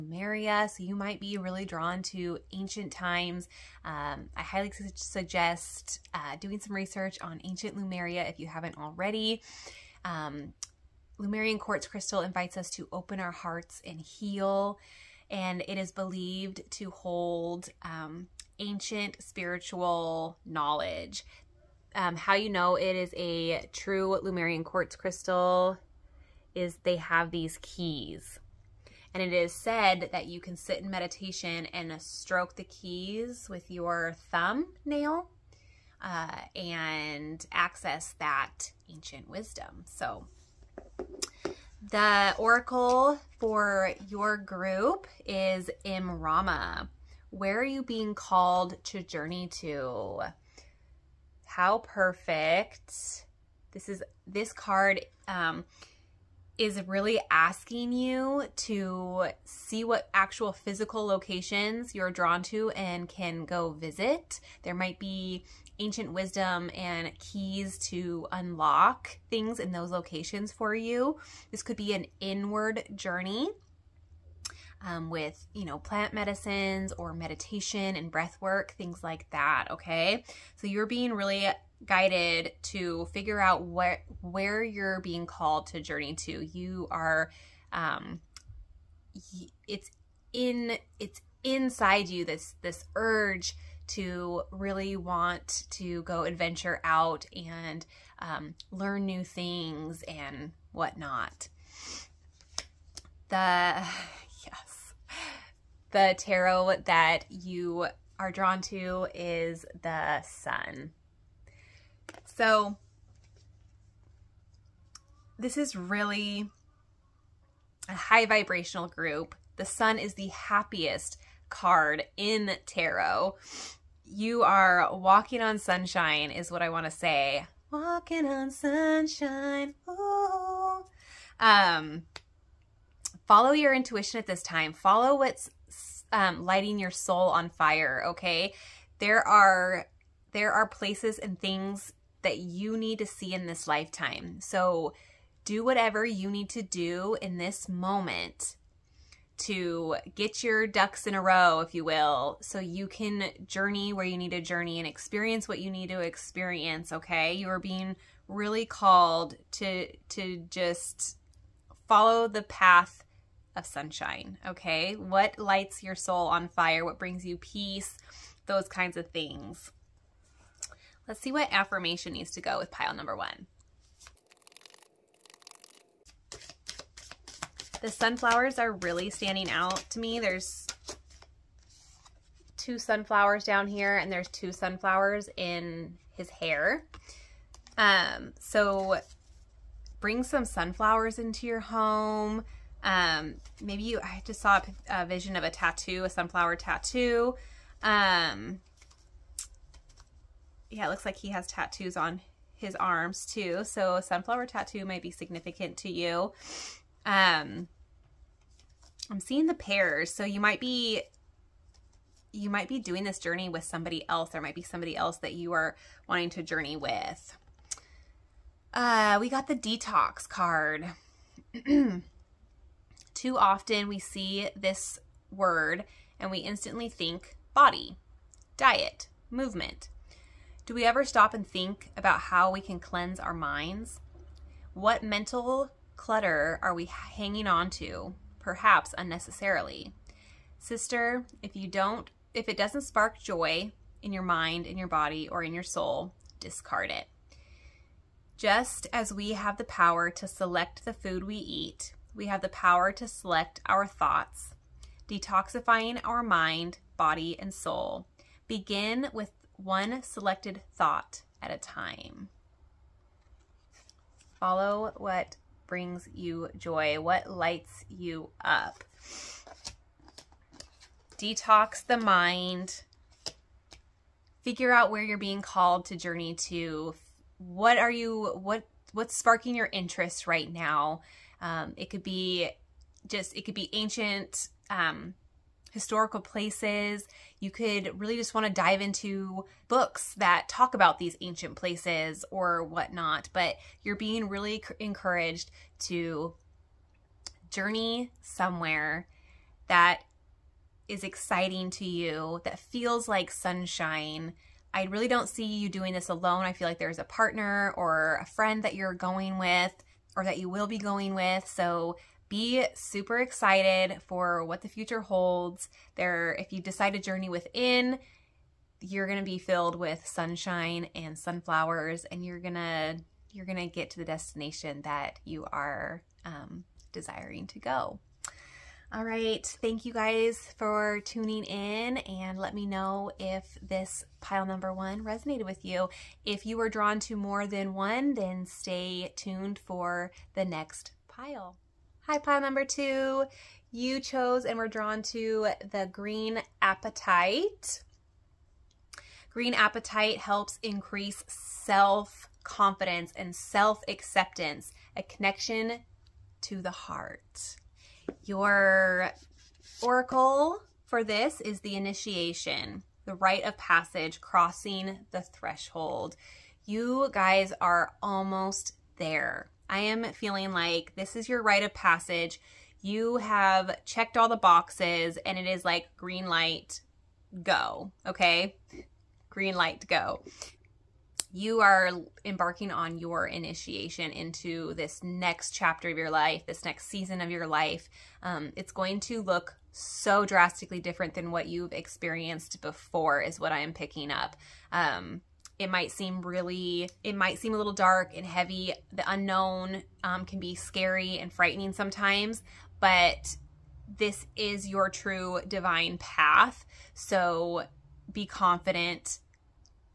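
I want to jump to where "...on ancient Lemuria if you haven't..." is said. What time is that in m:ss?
0:07.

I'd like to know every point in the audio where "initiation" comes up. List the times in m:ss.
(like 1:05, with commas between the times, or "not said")
6:01, 6:23.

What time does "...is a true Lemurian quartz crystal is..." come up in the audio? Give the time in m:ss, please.
0:22.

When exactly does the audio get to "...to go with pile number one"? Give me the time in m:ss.
2:52.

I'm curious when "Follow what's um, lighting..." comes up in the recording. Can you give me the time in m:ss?
2:14.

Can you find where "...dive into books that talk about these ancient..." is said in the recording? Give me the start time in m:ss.
4:48.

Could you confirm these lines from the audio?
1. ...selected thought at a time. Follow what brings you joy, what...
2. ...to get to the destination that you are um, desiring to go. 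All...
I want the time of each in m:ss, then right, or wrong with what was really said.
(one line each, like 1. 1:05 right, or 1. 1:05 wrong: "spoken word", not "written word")
1. 4:20 right
2. 5:23 right.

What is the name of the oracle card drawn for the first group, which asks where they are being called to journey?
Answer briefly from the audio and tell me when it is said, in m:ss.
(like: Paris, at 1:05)
Imrama, at 0:45.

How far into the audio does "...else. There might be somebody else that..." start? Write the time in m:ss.
3:34.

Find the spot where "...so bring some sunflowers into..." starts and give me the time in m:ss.
3:08.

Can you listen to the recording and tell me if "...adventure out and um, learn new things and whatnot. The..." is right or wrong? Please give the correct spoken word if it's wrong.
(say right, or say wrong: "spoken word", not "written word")
right.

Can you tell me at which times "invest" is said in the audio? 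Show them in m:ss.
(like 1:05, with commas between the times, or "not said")
not said.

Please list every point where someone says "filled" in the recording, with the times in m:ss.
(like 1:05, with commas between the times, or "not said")
5:19.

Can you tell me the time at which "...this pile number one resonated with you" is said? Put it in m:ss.
5:33.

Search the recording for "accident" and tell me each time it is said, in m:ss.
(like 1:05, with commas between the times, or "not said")
not said.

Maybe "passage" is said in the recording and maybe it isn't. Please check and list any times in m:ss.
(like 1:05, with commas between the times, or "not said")
6:03, 6:11.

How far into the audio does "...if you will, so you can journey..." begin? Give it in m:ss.
2:31.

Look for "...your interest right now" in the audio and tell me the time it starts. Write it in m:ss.
4:39.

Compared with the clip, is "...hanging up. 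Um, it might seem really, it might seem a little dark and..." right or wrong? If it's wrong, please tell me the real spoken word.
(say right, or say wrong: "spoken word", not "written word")
wrong: "picking", not "hanging".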